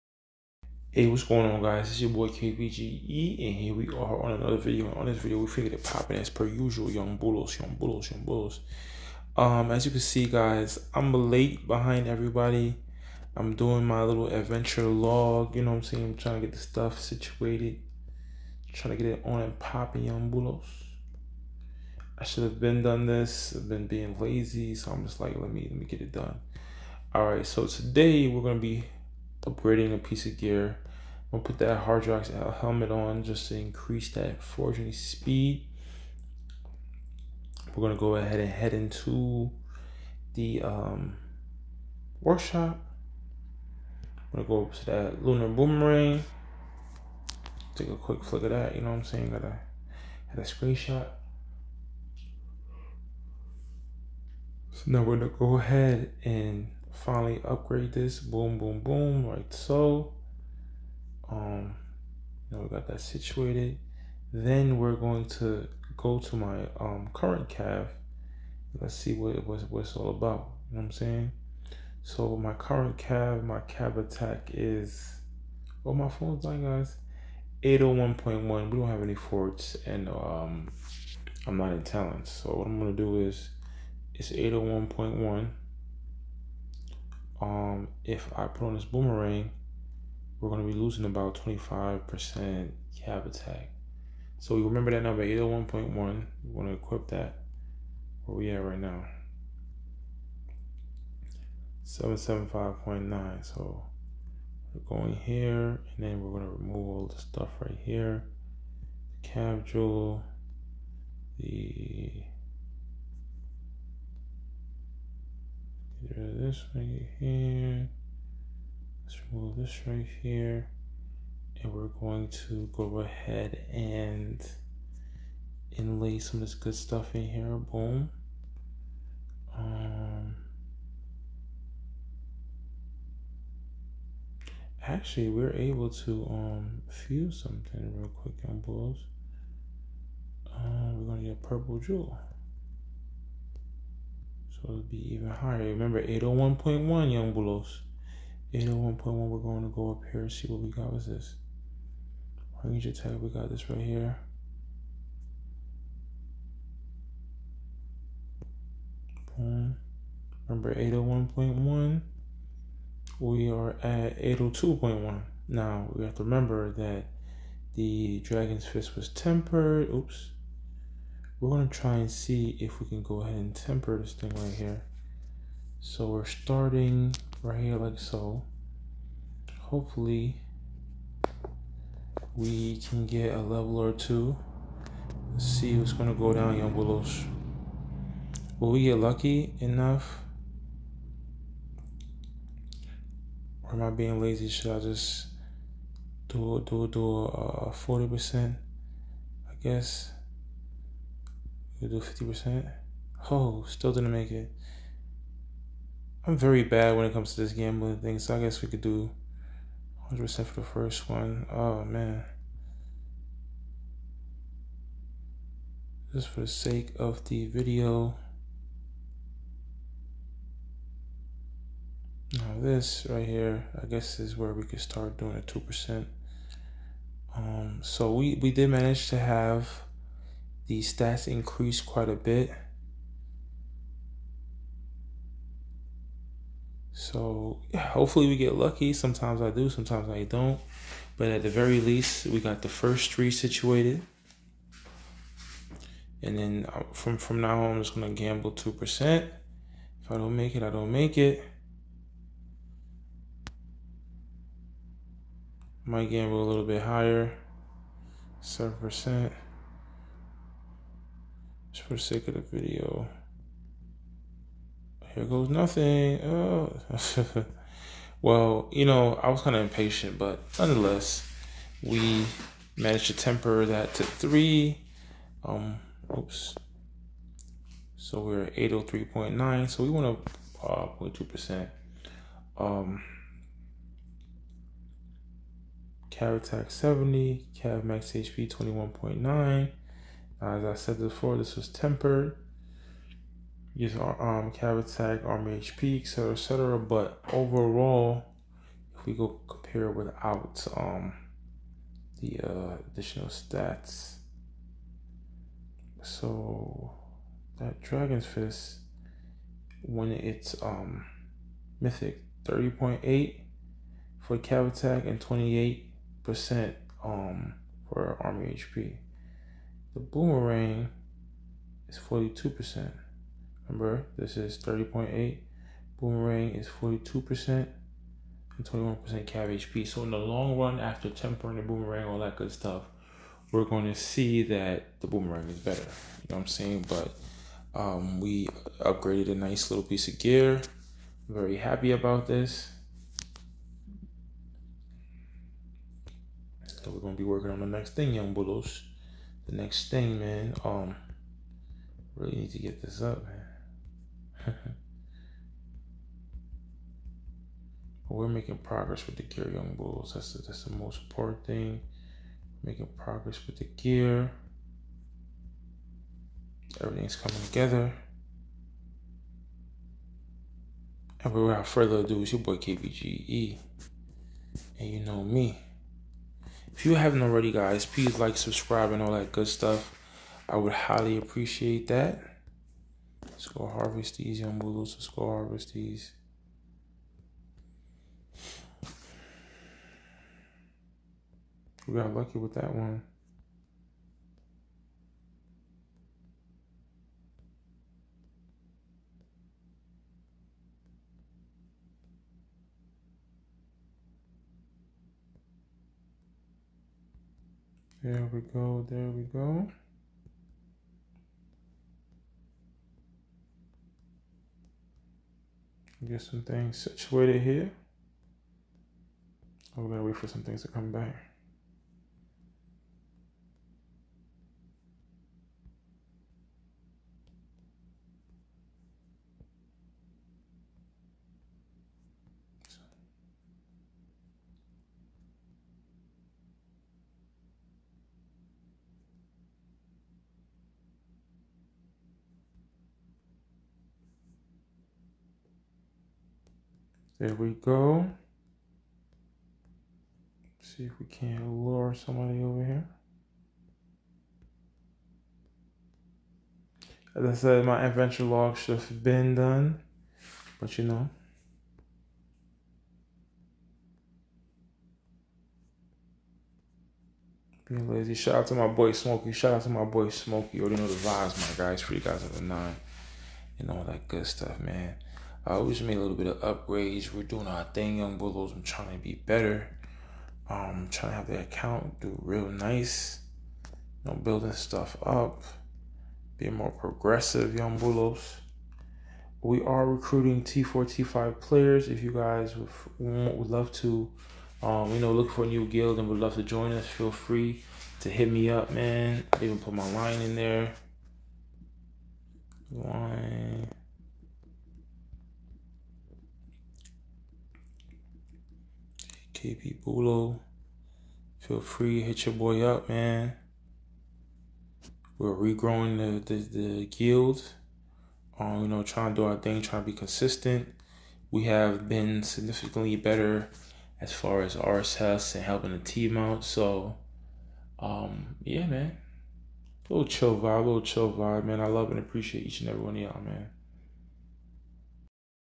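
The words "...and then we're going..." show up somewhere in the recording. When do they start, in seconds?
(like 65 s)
105 s.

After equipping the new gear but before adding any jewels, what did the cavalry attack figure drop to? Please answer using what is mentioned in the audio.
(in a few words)
775.9.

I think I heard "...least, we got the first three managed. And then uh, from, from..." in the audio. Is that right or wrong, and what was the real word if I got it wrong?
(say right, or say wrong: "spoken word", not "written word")
wrong: "situated", not "managed".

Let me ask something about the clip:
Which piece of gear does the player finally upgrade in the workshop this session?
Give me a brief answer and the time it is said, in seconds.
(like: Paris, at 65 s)
lunar boomerang, at 45 s.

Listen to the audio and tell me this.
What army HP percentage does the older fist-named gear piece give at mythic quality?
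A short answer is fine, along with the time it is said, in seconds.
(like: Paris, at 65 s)
28%, at 315 s.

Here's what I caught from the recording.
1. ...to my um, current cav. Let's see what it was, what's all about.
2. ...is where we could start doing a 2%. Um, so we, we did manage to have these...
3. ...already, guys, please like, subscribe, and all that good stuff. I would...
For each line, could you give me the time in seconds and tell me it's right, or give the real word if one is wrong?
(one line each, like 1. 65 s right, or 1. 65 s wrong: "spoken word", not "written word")
1. 66 s right
2. 224 s right
3. 377 s right.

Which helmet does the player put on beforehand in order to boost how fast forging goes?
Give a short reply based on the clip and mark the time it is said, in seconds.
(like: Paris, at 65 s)
Hardrock helmet, at 31 s.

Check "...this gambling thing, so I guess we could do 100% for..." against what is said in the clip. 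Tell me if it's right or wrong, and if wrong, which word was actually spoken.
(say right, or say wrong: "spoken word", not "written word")
right.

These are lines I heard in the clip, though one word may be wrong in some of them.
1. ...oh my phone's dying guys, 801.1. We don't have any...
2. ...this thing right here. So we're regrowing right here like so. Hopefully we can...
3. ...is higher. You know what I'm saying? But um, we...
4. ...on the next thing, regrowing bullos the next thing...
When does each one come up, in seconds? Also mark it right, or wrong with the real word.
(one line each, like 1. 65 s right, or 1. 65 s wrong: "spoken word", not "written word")
1. 75 s right
2. 173 s wrong: "starting", not "regrowing"
3. 335 s wrong: "better", not "higher"
4. 347 s wrong: "young", not "regrowing".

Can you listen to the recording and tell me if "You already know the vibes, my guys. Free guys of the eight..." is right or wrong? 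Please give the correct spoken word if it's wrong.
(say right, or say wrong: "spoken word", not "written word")
wrong: "nine", not "eight".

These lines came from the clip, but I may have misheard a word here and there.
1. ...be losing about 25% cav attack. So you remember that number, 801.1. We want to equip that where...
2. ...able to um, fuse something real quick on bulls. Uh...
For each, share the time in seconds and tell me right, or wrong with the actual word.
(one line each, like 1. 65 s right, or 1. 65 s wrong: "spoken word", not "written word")
1. 90 s right
2. 135 s right.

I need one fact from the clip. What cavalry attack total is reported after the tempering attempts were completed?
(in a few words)
803.9.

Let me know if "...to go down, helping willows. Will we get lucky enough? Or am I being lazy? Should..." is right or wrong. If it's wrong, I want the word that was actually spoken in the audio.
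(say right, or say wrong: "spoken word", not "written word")
wrong: "young", not "helping".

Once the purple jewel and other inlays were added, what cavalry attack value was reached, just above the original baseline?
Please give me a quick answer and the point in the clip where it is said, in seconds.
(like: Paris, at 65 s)
802.1, at 164 s.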